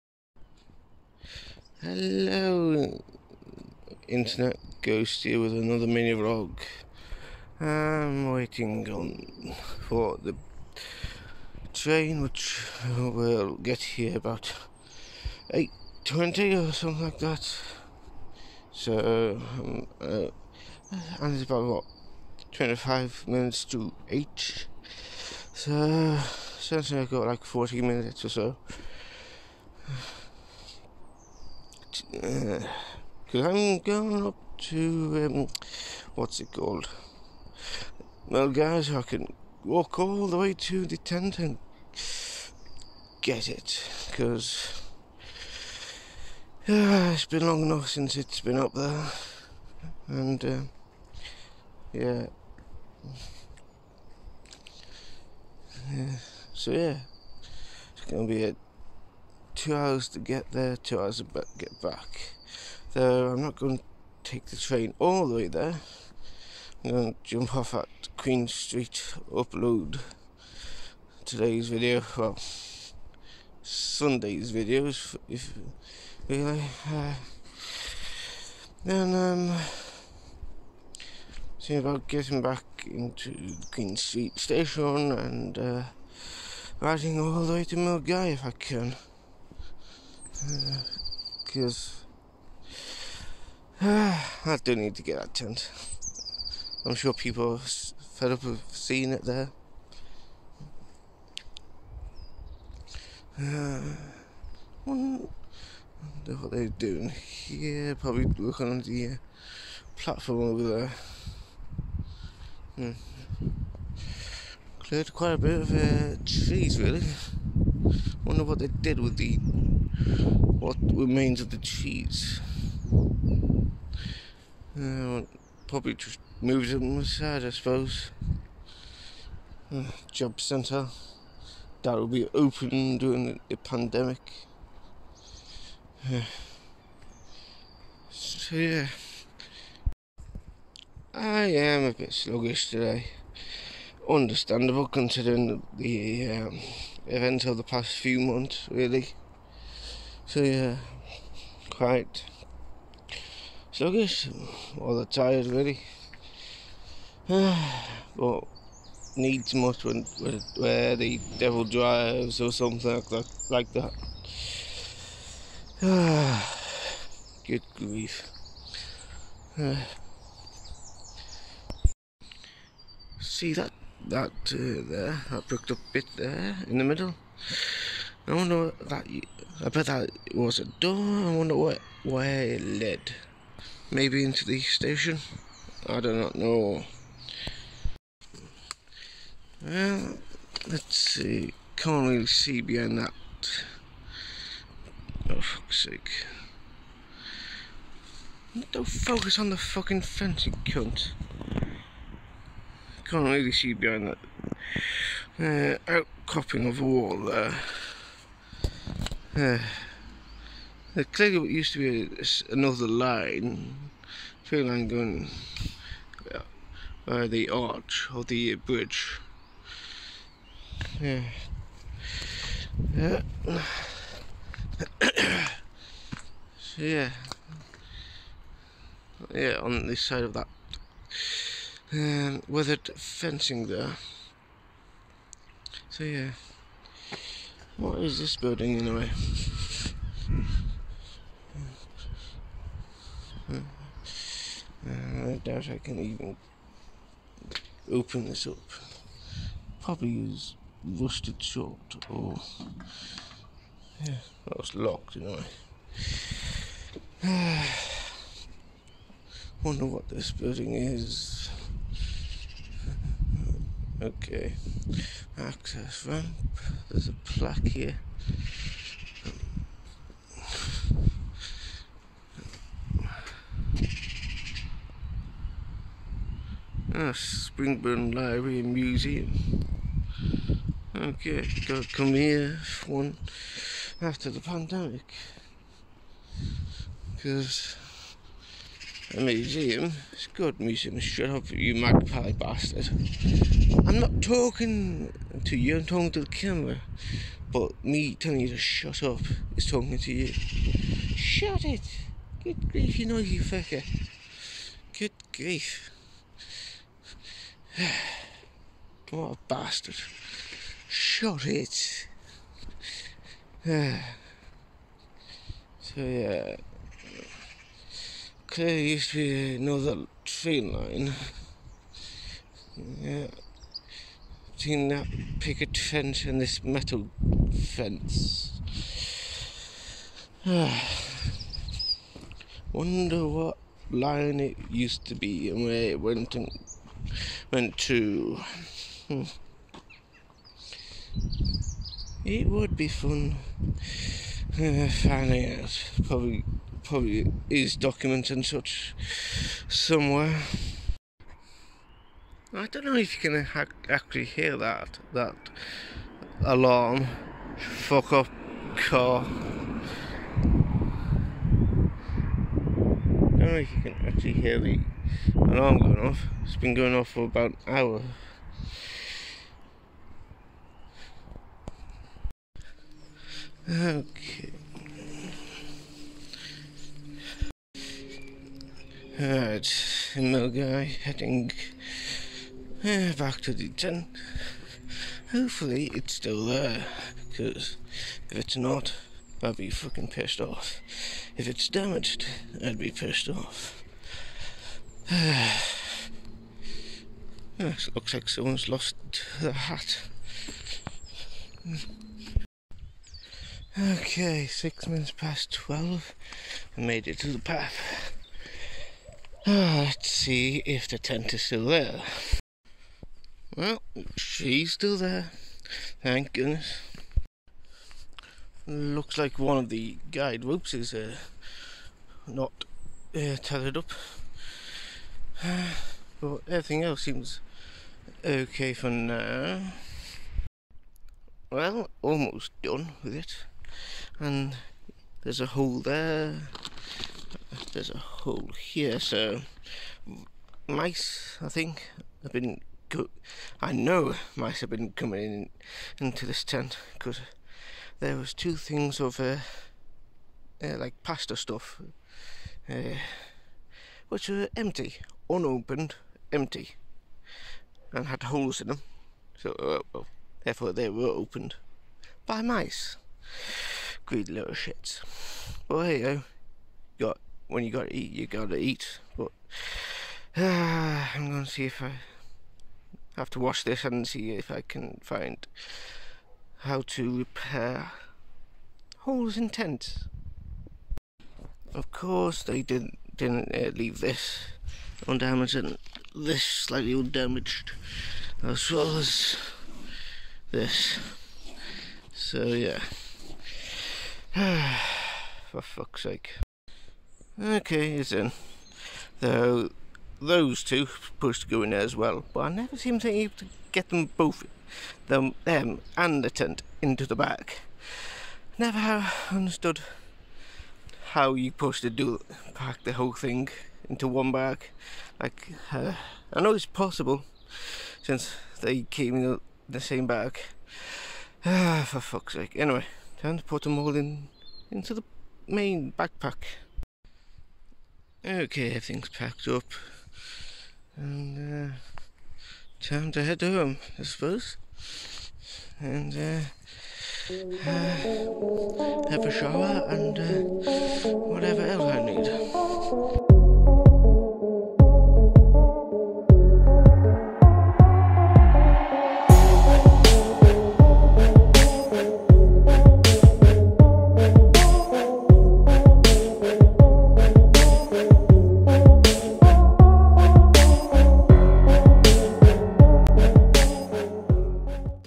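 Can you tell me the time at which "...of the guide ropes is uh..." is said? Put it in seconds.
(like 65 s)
419 s.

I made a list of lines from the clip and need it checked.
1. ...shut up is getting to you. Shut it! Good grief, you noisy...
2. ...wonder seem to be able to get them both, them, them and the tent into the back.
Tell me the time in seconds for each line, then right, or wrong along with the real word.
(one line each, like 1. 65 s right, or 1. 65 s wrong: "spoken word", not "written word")
1. 298 s wrong: "talking", not "getting"
2. 502 s wrong: "never", not "wonder".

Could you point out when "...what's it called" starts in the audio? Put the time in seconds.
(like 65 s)
36 s.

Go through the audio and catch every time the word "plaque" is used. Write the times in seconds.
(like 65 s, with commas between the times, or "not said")
267 s.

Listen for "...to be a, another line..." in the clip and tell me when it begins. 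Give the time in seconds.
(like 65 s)
211 s.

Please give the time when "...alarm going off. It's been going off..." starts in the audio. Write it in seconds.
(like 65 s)
365 s.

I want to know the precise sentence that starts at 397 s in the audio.
looks like someone's lost the hat.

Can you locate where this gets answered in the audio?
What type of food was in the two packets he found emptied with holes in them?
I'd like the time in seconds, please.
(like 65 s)
451 s.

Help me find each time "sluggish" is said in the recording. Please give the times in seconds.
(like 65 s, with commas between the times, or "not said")
142 s, 153 s.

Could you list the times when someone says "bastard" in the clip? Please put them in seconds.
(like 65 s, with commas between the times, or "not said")
292 s, 309 s.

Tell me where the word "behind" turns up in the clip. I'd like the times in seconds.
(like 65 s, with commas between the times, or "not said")
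192 s, 203 s.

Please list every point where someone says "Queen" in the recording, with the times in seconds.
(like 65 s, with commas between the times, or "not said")
68 s, 83 s.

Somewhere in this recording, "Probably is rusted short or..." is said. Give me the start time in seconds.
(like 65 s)
249 s.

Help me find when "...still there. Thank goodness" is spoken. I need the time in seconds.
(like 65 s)
414 s.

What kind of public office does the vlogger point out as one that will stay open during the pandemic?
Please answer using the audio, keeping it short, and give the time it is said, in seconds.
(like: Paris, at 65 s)
Job centre, at 130 s.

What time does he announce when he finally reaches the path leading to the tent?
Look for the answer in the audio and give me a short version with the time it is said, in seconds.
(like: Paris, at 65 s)
12:06, at 404 s.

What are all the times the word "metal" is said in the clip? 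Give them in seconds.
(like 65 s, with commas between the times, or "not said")
326 s.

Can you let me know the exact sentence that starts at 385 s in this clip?
Hopefully it's still there, because if it's not, I'd be fucking pissed off.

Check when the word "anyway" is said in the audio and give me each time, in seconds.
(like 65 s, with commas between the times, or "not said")
238 s, 255 s, 522 s.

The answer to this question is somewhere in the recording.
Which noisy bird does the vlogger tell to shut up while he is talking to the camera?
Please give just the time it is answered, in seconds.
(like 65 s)
291 s.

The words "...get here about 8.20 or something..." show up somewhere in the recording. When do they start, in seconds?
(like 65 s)
13 s.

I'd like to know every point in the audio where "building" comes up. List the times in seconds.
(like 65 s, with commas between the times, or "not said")
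238 s, 260 s.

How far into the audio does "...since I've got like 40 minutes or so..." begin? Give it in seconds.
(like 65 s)
26 s.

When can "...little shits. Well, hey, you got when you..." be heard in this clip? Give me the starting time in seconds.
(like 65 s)
464 s.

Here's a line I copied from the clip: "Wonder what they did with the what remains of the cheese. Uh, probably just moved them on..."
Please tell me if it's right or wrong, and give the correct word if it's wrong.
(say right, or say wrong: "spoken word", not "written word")
right.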